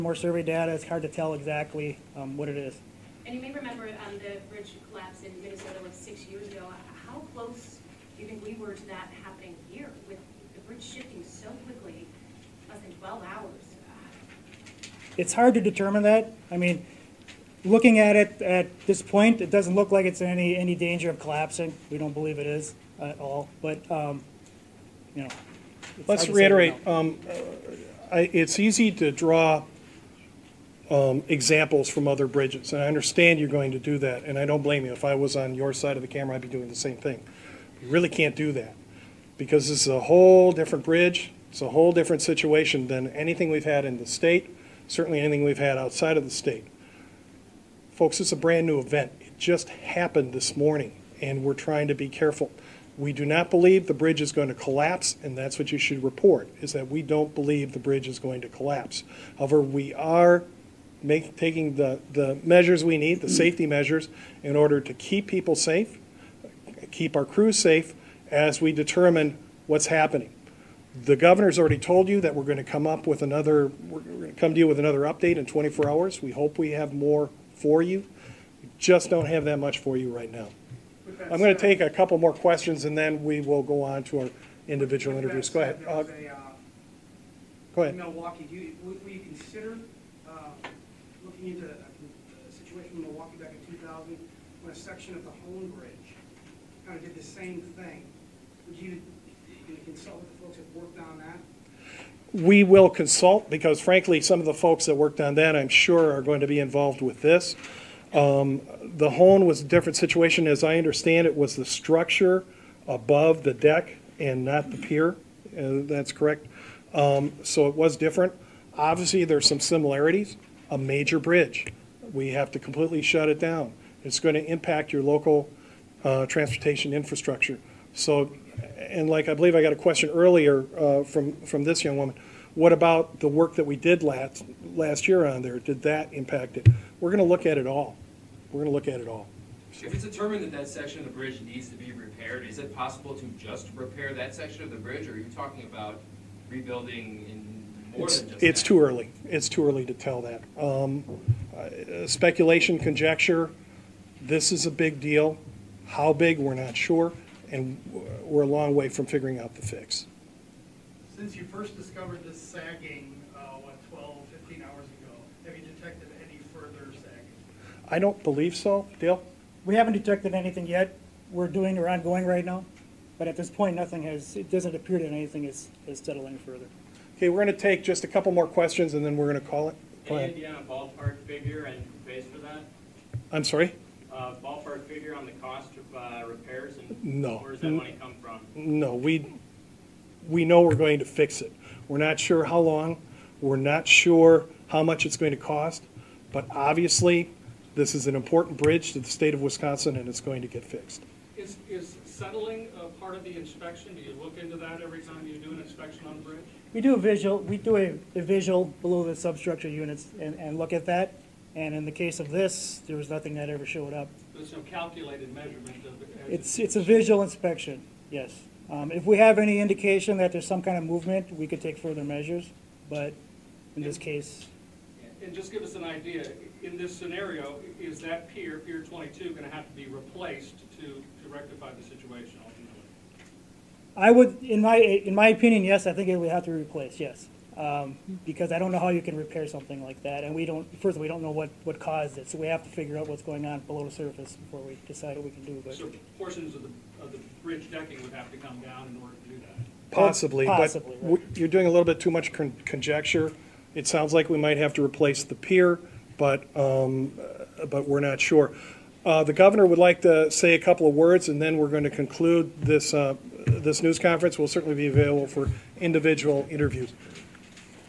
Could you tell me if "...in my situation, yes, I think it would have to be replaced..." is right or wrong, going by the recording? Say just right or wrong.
wrong.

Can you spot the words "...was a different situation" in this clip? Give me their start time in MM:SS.
01:49.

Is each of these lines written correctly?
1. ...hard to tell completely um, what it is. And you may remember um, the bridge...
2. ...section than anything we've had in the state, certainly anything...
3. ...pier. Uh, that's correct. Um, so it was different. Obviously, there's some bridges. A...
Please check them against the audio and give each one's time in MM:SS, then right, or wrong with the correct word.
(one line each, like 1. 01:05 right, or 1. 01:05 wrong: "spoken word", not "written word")
1. 00:00 wrong: "exactly", not "completely"
2. 00:42 wrong: "situation", not "section"
3. 01:54 wrong: "similarities", not "bridges".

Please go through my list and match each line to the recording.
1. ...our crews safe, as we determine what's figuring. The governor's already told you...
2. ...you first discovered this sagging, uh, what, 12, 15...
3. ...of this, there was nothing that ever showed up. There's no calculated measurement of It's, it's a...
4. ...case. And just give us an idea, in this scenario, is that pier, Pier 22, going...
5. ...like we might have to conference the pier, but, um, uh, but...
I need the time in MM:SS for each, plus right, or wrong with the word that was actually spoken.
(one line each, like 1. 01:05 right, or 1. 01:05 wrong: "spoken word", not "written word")
1. 01:07 wrong: "happening", not "figuring"
2. 02:41 right
3. 03:32 right
4. 03:43 right
5. 04:14 wrong: "replace", not "conference".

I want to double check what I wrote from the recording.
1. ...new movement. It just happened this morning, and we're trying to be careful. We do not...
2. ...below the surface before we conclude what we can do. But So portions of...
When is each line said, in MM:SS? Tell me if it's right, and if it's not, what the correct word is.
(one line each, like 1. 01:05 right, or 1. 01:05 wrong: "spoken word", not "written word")
1. 00:48 wrong: "event", not "movement"
2. 04:03 wrong: "decide", not "conclude".